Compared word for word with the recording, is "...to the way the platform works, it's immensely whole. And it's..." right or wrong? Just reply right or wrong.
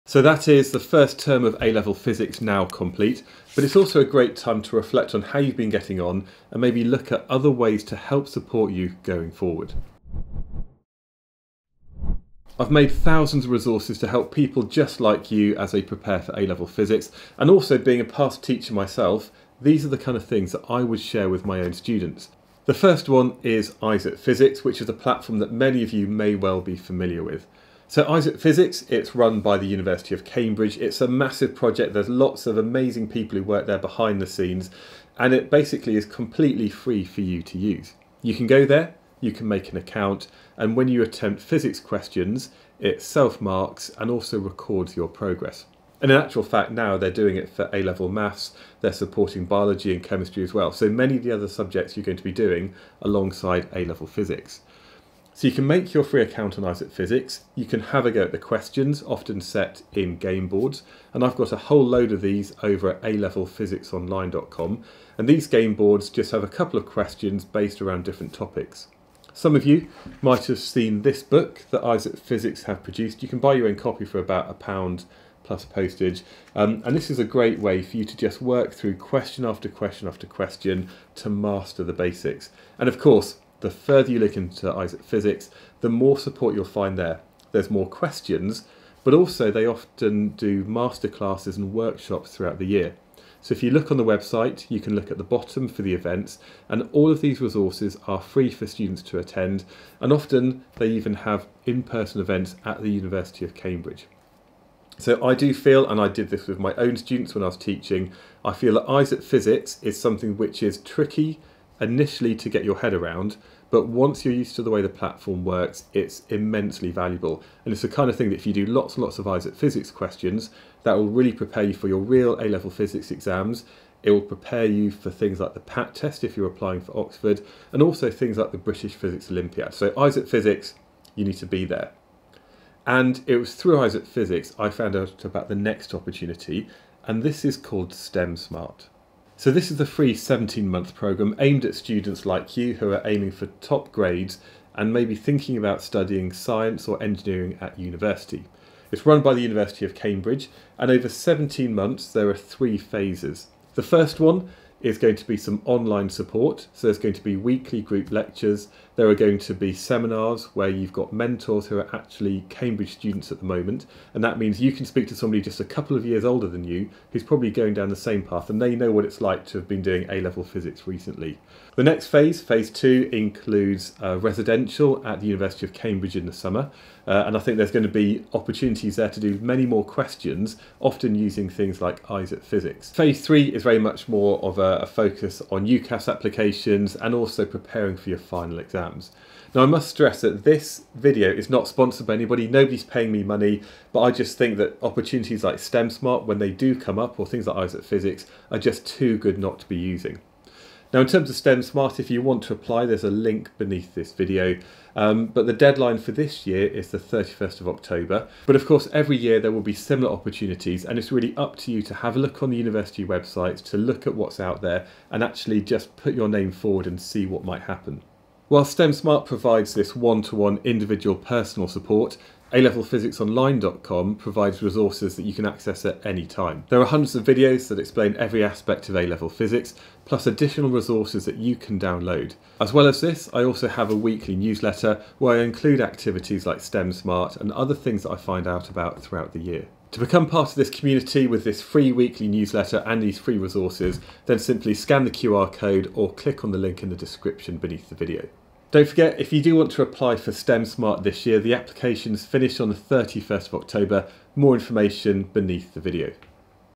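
wrong.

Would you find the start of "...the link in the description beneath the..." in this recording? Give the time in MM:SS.
04:06.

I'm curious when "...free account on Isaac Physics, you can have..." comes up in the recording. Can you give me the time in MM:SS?
00:56.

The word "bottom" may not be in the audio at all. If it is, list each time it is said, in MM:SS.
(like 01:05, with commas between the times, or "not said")
01:35.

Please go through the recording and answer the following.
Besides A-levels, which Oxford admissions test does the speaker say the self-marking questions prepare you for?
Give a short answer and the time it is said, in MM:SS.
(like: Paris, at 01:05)
PAT test, at 02:05.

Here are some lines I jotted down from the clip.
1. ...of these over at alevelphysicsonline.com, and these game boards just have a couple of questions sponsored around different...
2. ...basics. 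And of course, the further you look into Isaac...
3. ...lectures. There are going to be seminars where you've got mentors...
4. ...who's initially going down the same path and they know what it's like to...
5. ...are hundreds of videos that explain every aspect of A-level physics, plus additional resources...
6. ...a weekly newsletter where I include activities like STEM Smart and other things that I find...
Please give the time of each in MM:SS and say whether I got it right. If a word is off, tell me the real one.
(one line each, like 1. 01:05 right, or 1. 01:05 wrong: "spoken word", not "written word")
1. 01:02 wrong: "based", not "sponsored"
2. 01:21 right
3. 02:38 right
4. 02:47 wrong: "probably", not "initially"
5. 03:46 right
6. 03:53 right.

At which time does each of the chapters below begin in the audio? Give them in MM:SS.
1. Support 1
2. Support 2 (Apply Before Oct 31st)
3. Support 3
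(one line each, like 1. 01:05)
1. 00:22
2. 02:16
3. 03:38.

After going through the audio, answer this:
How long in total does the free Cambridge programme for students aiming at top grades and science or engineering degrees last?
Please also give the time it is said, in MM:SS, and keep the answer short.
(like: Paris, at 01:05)
17 months, at 02:20.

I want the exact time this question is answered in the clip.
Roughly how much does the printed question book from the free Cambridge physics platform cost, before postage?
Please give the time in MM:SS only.
01:14.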